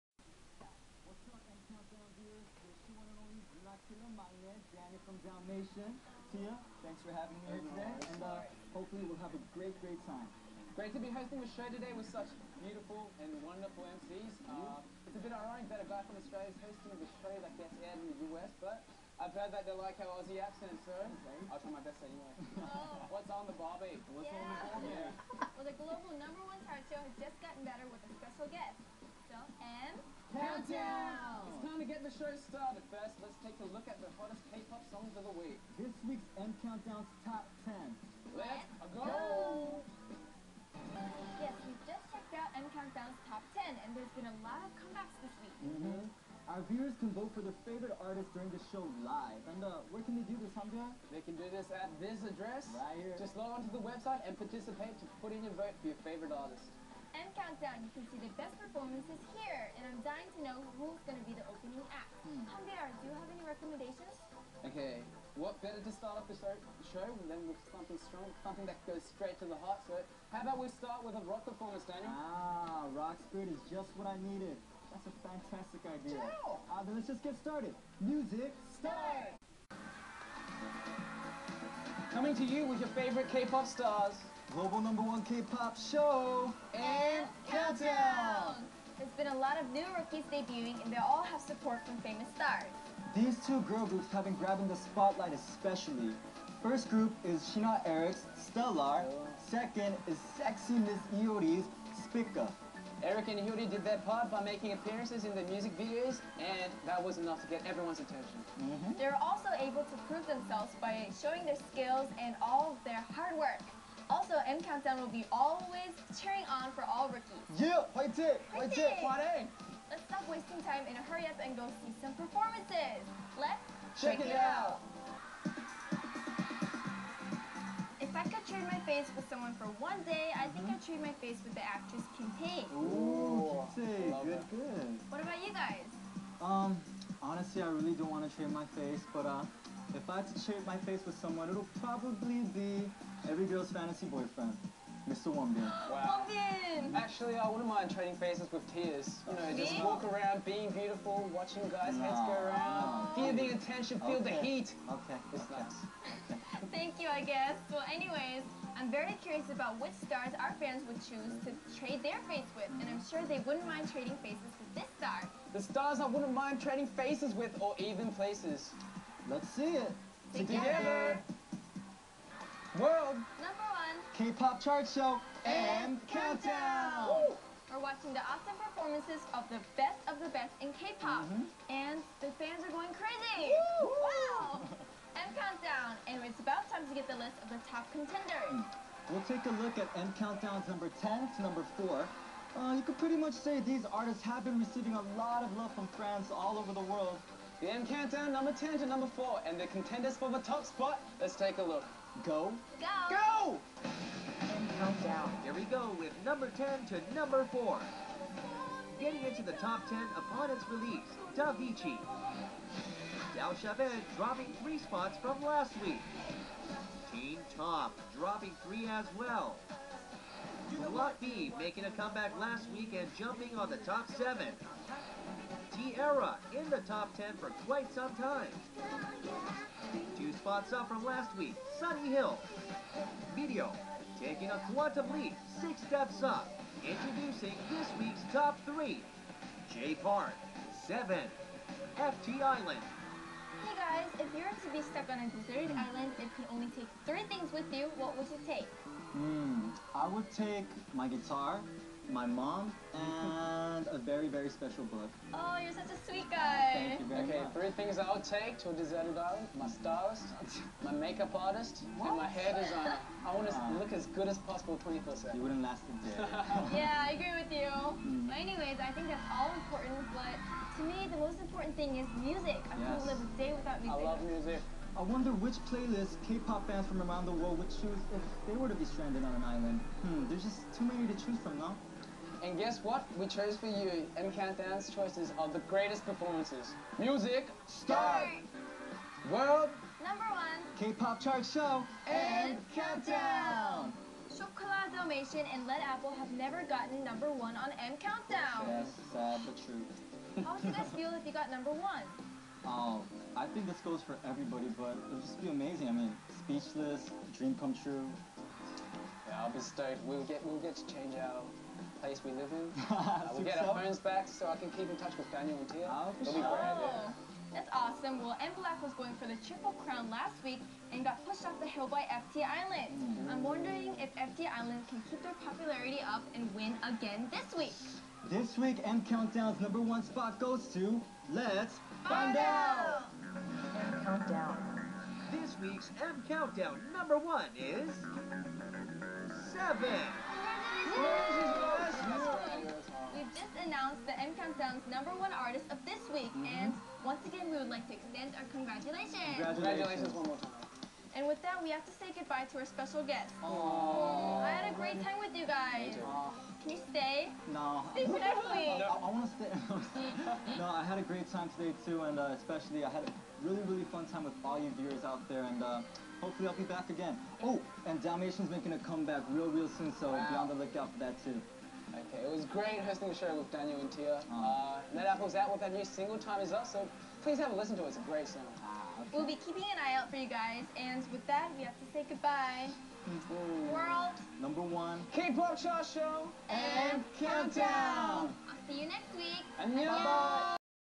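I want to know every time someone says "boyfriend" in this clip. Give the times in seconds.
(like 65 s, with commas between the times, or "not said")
144 s.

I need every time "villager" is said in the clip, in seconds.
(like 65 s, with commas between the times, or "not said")
not said.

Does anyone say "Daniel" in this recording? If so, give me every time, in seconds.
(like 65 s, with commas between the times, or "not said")
71 s, 315 s, 373 s.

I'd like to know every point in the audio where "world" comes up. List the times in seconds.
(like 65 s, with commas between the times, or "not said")
172 s, 196 s, 277 s, 289 s, 383 s.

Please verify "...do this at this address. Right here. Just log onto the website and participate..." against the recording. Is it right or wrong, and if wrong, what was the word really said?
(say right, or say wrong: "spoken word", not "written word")
right.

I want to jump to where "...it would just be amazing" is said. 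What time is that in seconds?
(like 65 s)
304 s.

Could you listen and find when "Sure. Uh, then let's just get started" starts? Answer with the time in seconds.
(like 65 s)
76 s.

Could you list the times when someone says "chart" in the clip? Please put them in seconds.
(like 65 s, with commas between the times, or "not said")
26 s, 174 s, 291 s.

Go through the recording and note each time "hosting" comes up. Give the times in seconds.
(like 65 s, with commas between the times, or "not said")
11 s, 16 s, 372 s.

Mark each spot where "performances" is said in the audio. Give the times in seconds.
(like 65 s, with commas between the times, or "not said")
58 s, 71 s, 122 s, 178 s, 286 s.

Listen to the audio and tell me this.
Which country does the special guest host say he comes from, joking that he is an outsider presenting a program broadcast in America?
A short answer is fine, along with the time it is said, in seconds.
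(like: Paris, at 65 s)
Australia, at 16 s.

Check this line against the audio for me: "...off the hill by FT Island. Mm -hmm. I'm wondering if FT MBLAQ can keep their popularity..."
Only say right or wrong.
wrong.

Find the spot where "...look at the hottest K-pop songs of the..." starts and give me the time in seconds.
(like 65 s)
33 s.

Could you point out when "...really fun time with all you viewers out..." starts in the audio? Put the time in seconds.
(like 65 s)
363 s.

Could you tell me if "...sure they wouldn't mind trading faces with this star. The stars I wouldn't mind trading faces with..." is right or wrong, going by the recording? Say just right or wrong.
right.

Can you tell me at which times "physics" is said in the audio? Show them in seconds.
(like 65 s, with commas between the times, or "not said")
not said.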